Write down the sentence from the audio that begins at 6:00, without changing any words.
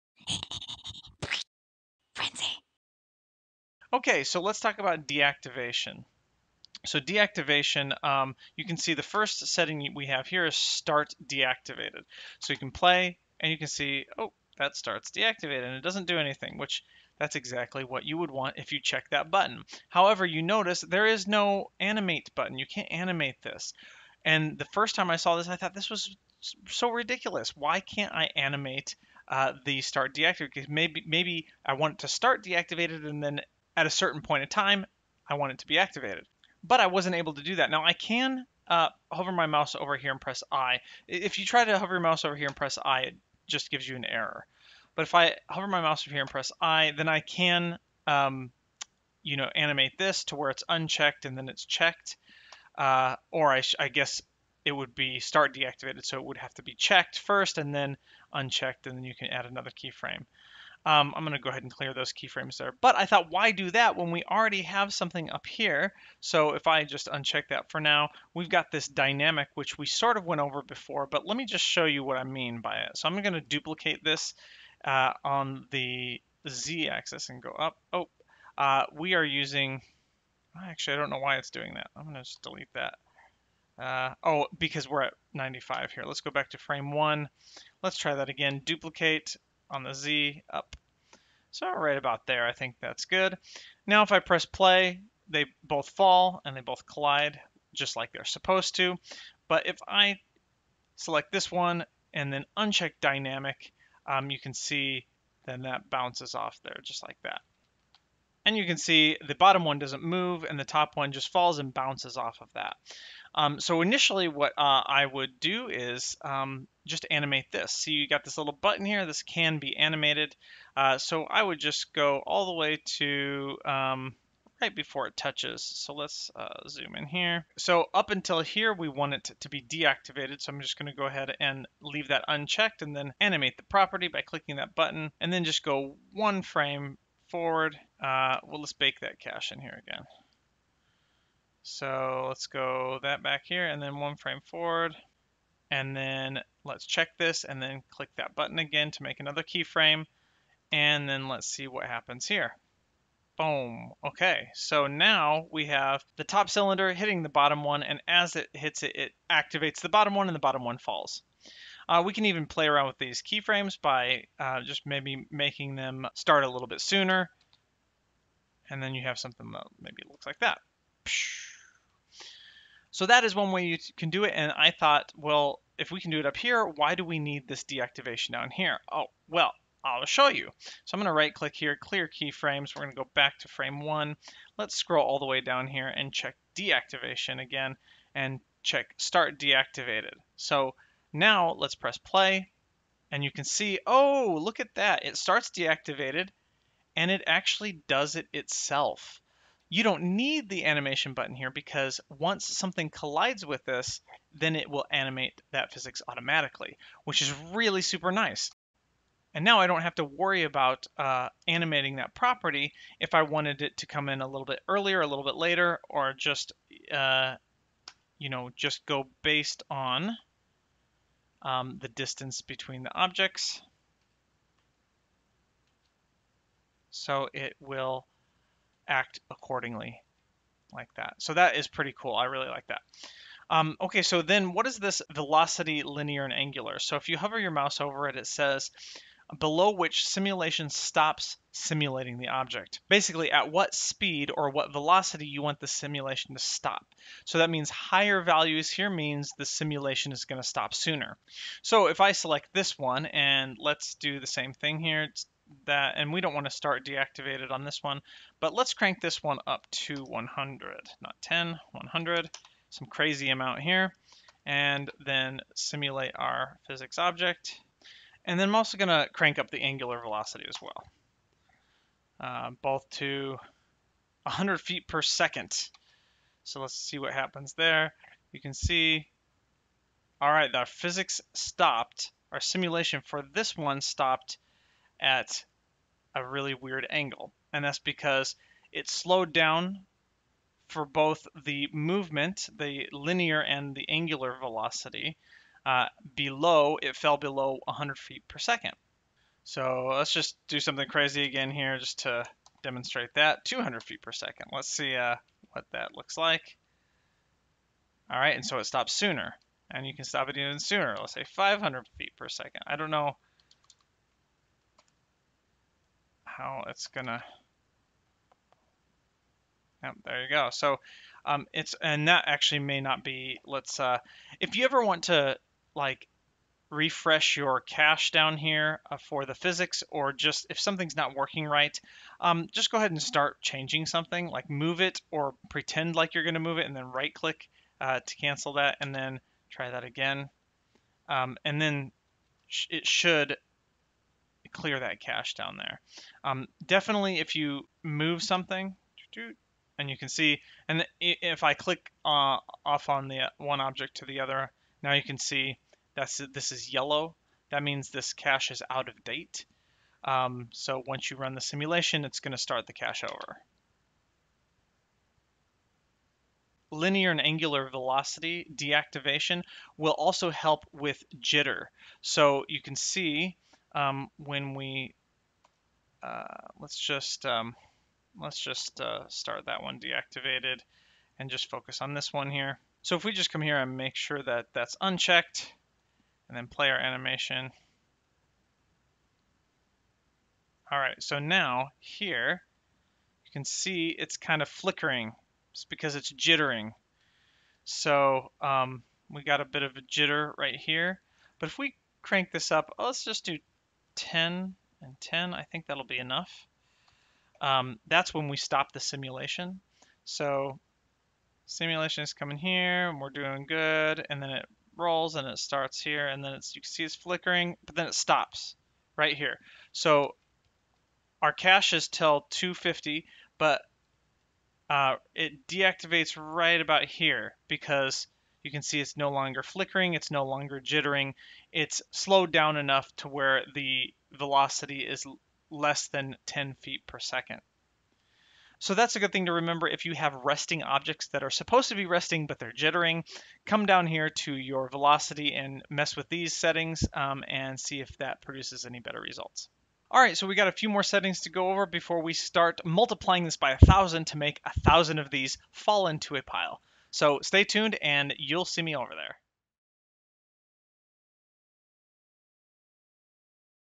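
Um, so once you run the simulation, it's going to start the cache over.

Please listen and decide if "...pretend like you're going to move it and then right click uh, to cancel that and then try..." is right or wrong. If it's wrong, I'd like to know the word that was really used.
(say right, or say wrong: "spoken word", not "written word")
right.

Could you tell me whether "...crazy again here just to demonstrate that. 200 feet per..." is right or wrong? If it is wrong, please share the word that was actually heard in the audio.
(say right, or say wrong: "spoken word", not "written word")
right.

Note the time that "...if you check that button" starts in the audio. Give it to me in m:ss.
0:18.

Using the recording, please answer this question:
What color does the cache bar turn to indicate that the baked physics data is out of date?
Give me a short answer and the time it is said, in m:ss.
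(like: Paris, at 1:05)
Yellow, at 5:56.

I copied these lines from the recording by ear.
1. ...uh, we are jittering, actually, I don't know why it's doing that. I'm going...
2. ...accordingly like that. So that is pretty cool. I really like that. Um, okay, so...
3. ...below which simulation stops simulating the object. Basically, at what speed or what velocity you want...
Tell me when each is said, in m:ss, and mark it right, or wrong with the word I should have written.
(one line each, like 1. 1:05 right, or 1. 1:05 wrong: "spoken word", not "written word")
1. 1:18 wrong: "using", not "jittering"
2. 3:49 right
3. 3:59 right.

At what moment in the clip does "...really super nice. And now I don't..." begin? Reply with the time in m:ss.
3:27.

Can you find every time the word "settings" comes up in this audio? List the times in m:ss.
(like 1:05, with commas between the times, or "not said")
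0:09, 7:26, 7:30.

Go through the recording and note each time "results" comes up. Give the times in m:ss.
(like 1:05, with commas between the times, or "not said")
7:29.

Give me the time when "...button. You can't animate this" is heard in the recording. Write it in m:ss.
0:22.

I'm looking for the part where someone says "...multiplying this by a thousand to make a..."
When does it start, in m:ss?
7:32.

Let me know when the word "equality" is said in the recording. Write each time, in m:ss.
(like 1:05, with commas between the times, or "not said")
not said.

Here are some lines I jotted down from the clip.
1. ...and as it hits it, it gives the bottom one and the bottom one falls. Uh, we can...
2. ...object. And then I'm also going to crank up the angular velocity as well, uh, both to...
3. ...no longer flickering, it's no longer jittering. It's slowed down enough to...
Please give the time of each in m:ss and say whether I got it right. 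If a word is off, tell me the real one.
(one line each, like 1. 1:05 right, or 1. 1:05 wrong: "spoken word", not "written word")
1. 2:37 wrong: "activates", not "gives"
2. 4:26 right
3. 7:08 right.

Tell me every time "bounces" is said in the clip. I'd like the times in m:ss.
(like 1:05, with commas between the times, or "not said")
1:45, 1:51.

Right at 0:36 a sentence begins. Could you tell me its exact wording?
But I wasn't able to do that.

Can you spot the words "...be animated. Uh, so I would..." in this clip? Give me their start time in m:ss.
1:59.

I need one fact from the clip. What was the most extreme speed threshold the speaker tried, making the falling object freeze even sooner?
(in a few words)
500 feet per second.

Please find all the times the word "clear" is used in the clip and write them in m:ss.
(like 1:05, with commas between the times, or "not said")
1:01, 3:01, 5:44.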